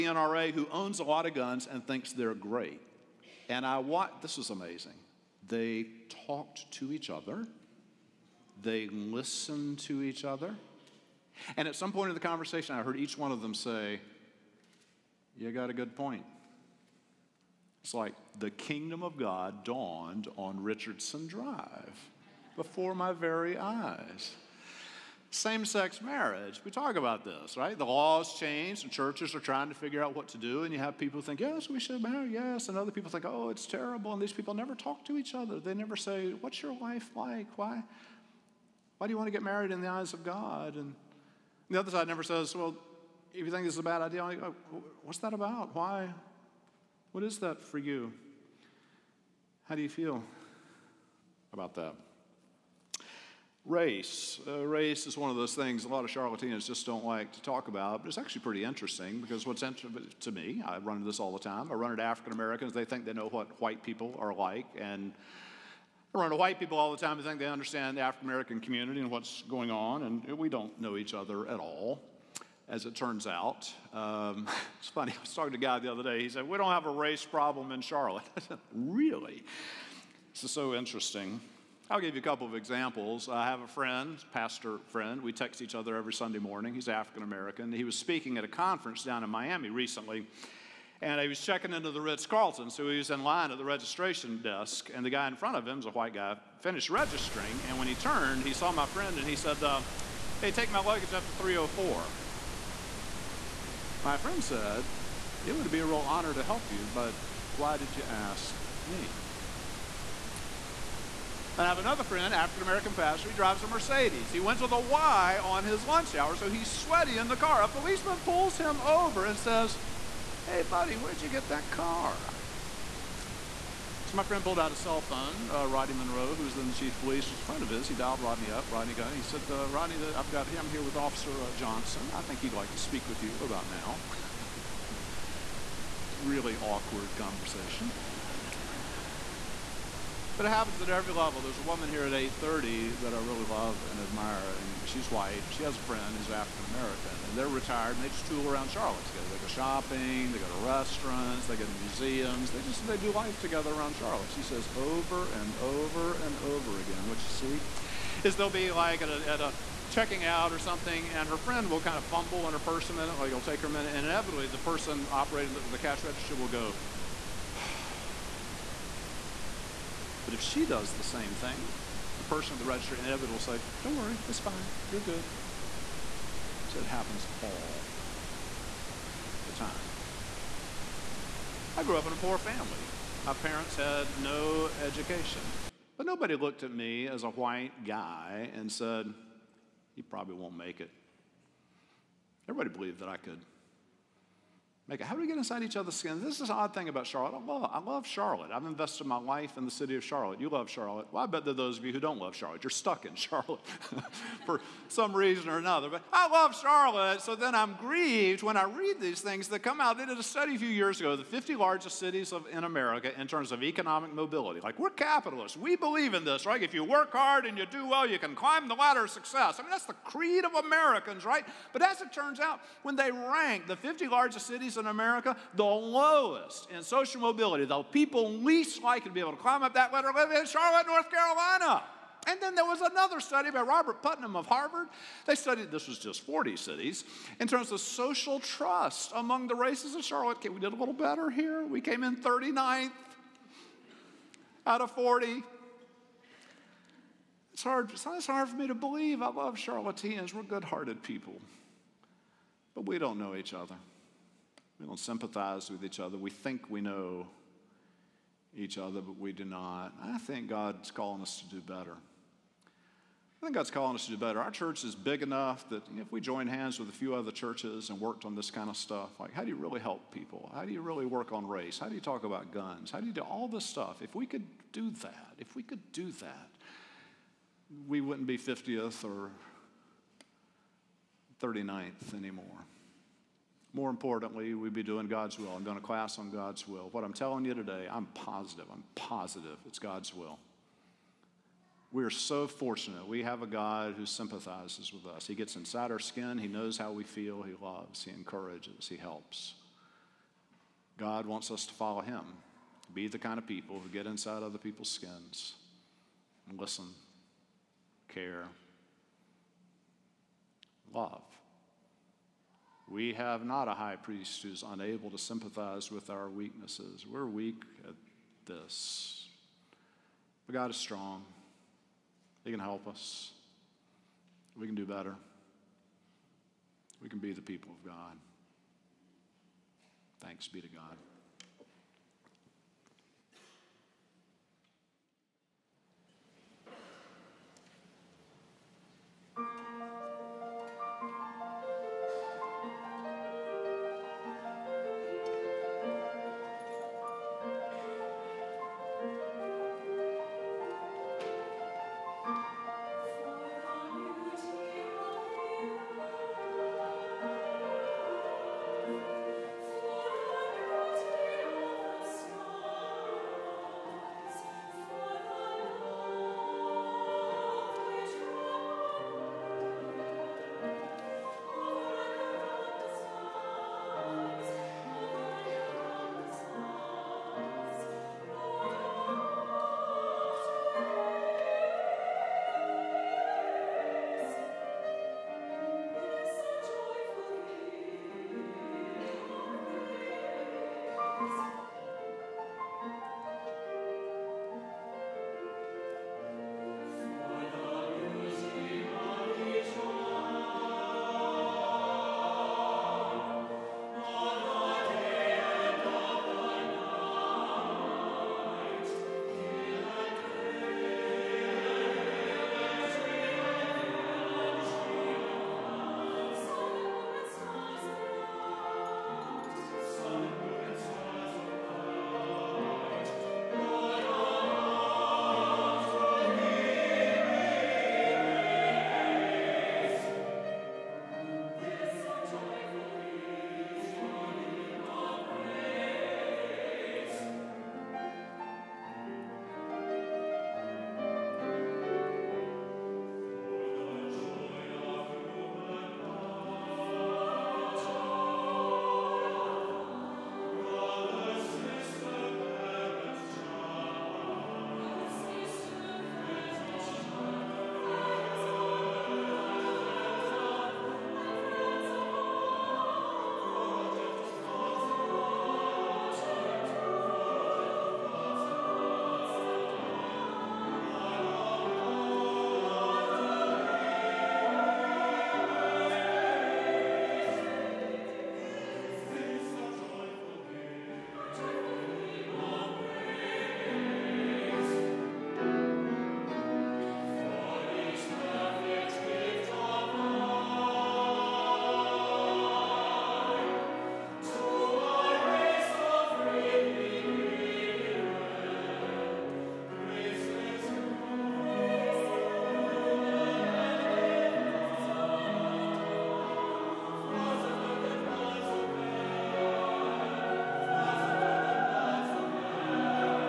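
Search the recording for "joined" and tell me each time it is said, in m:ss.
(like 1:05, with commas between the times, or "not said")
4:26.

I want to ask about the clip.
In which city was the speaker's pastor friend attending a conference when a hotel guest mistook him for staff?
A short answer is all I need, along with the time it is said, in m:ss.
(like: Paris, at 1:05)
Miami, at 1:29.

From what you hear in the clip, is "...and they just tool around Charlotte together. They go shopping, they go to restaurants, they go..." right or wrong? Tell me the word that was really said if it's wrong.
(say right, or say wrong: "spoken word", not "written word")
right.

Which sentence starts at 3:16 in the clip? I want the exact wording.
This is an odd thing about Charlotte.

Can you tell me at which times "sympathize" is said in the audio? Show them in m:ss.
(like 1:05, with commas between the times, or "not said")
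4:14, 4:54, 5:15.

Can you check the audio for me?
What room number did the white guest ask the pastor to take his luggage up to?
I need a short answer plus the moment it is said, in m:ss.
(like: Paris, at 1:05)
304, at 1:41.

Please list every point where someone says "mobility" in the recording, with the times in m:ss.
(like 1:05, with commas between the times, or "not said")
3:34, 3:47.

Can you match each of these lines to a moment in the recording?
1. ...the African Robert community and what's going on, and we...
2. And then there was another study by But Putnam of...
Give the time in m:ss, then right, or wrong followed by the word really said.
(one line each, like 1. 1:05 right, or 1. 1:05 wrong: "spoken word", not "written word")
1. 1:07 wrong: "American", not "Robert"
2. 3:52 wrong: "Robert", not "But".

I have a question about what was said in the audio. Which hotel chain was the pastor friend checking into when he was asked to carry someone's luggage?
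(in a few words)
Ritz Carlton.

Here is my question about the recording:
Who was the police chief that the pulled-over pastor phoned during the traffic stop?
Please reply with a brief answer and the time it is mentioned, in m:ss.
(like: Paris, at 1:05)
Rodney Monroe, at 2:05.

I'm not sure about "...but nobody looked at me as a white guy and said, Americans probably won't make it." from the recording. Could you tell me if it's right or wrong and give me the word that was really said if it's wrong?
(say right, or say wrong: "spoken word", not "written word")
wrong: "You", not "Americans".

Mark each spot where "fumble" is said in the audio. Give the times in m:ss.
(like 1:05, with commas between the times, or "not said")
2:42.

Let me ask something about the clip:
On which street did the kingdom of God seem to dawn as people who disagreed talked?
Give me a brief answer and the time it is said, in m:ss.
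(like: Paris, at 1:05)
Richardson Drive, at 0:20.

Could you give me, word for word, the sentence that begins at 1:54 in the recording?
He went to the Y on his lunch hour, so he's sweaty in the car.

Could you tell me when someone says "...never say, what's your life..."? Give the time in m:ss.
0:35.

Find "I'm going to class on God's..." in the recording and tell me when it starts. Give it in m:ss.
4:45.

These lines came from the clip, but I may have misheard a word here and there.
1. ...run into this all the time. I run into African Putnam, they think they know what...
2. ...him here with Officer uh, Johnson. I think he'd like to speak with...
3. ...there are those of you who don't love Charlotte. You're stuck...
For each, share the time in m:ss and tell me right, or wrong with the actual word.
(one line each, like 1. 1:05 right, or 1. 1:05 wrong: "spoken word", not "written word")
1. 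1:00 wrong: "Americans", not "Putnam"
2. 2:10 right
3. 3:21 right.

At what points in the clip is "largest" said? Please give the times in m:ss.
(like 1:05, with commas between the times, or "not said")
3:31, 3:44.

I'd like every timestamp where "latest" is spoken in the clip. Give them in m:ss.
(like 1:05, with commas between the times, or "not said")
not said.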